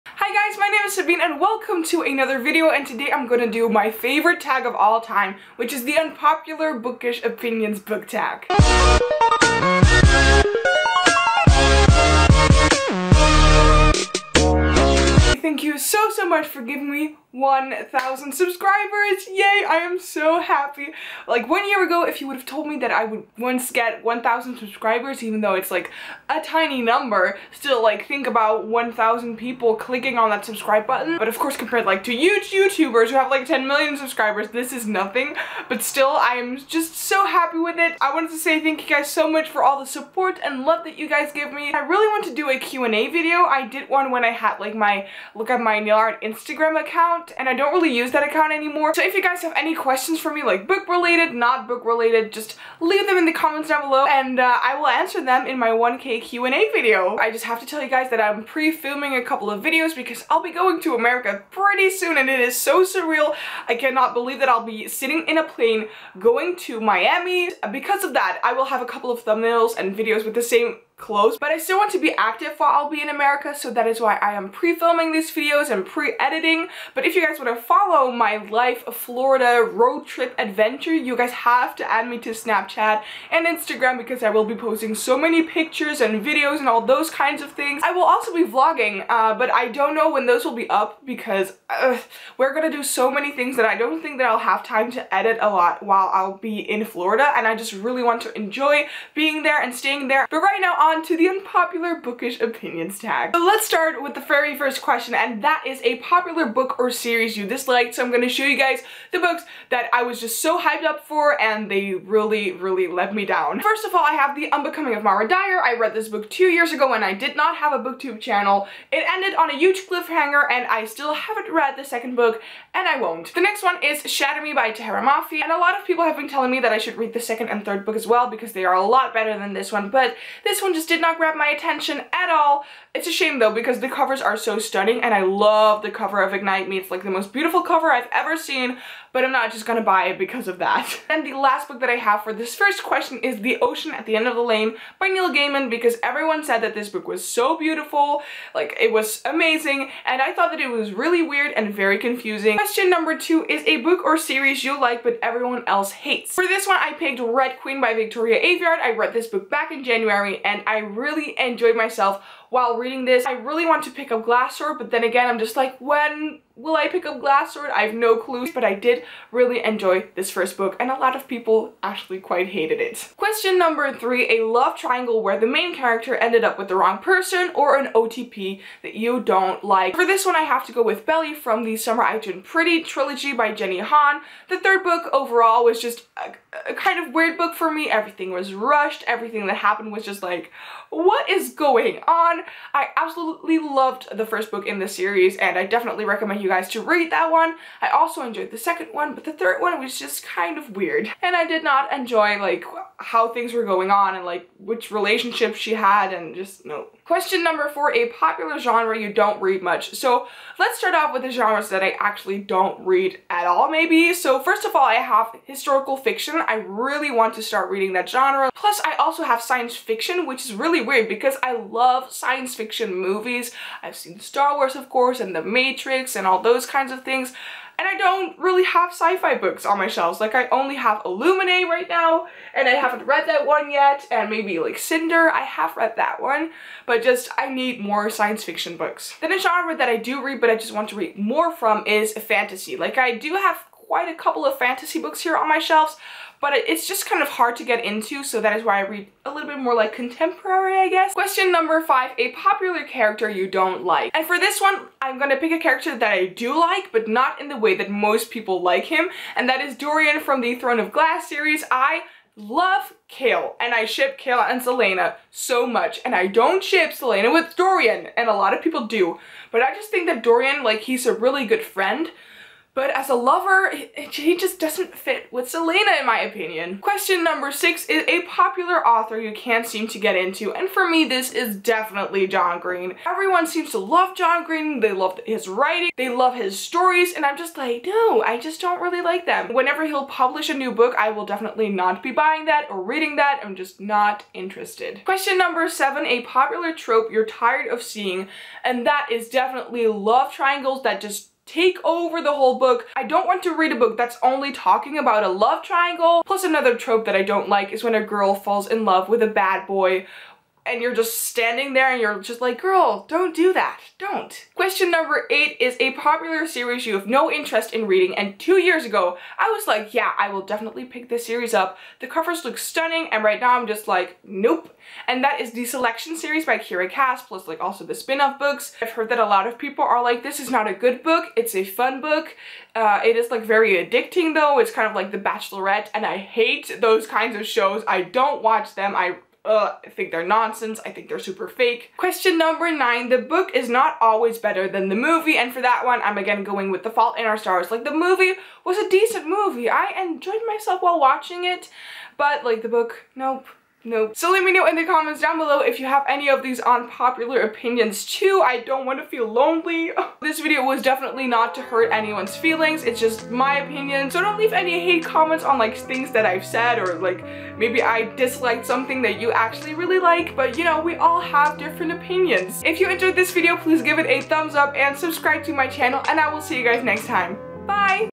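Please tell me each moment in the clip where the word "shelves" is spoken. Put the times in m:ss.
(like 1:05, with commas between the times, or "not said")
3:49, 4:05.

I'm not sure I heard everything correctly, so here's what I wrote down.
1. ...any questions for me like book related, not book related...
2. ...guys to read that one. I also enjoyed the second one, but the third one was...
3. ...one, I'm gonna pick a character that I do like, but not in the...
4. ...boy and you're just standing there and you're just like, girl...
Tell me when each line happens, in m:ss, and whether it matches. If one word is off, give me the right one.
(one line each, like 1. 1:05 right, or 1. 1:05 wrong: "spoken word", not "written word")
1. 0:49 right
2. 3:16 right
3. 4:14 right
4. 5:09 right.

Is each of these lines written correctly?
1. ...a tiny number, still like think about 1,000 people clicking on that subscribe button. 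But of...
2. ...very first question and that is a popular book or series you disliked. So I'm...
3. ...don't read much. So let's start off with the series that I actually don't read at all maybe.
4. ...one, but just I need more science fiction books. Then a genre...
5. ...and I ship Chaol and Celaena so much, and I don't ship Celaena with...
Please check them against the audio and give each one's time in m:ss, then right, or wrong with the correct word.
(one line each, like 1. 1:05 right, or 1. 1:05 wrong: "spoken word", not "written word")
1. 0:26 right
2. 1:44 right
3. 3:29 wrong: "genres", not "series"
4. 3:56 right
5. 4:23 right.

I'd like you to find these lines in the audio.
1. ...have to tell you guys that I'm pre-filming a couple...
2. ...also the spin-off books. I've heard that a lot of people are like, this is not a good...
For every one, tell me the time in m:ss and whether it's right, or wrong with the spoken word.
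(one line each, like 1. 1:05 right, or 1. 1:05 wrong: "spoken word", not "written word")
1. 0:57 right
2. 5:27 right.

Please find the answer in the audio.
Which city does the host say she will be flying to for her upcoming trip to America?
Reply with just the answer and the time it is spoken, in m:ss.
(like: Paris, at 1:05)
Miami, at 1:06.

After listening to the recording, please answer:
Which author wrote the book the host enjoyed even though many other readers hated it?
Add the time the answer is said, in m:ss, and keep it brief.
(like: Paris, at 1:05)
Victoria Aveyard, at 2:37.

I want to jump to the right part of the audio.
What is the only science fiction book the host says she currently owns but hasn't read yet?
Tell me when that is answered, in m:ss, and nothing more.
3:51.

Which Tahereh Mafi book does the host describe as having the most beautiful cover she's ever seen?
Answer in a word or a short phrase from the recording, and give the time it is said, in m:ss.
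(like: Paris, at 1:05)
Ignite Me, at 2:16.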